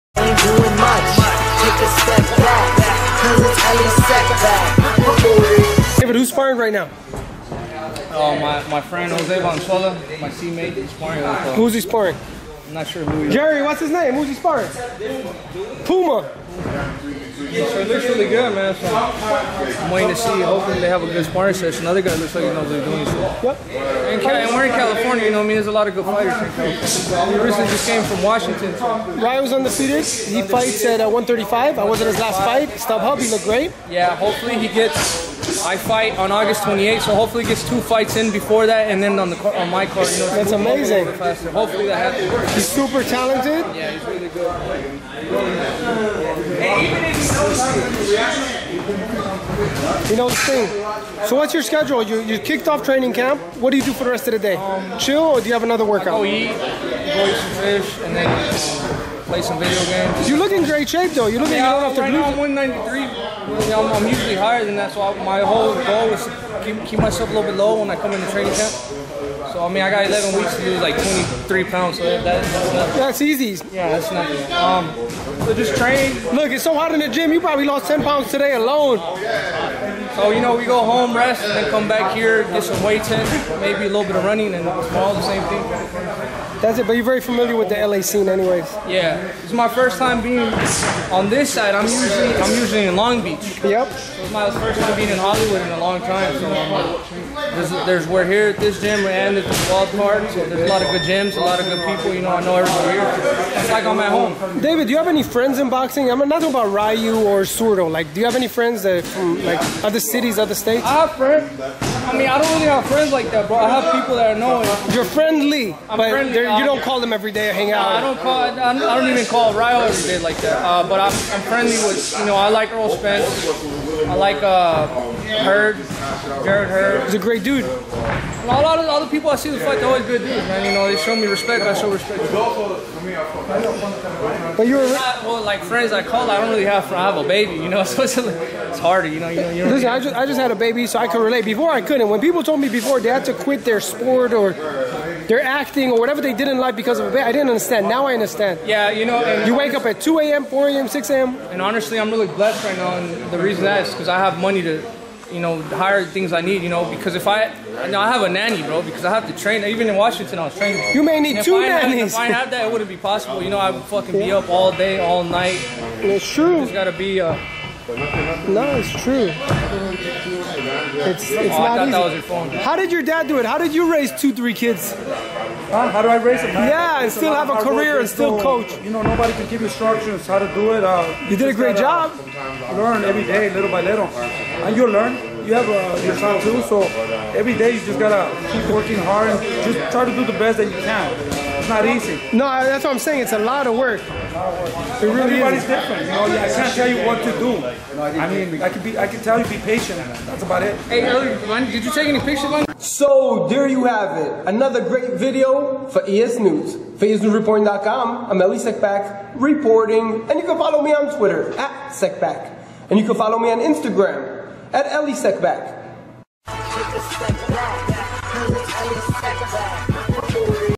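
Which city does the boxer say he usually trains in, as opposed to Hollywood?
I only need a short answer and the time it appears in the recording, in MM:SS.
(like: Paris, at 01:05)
Long Beach, at 01:32.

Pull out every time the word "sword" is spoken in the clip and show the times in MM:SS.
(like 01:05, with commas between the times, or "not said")
not said.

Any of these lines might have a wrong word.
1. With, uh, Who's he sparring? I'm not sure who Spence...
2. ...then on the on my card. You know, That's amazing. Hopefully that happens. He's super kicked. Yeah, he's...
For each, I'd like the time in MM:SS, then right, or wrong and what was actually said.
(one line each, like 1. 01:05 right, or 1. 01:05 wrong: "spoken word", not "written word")
1. 00:11 wrong: "Jerry", not "Spence"
2. 00:39 wrong: "talented", not "kicked".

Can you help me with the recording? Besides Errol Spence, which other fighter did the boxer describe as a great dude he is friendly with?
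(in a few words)
Jarrett Hurd.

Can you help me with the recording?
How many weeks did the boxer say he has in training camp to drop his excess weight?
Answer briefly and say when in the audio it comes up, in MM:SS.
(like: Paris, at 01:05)
11, at 01:10.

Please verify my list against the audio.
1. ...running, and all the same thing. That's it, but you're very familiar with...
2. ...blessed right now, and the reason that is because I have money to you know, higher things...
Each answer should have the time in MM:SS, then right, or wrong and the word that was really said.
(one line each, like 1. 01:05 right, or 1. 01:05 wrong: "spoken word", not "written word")
1. 01:24 right
2. 02:32 right.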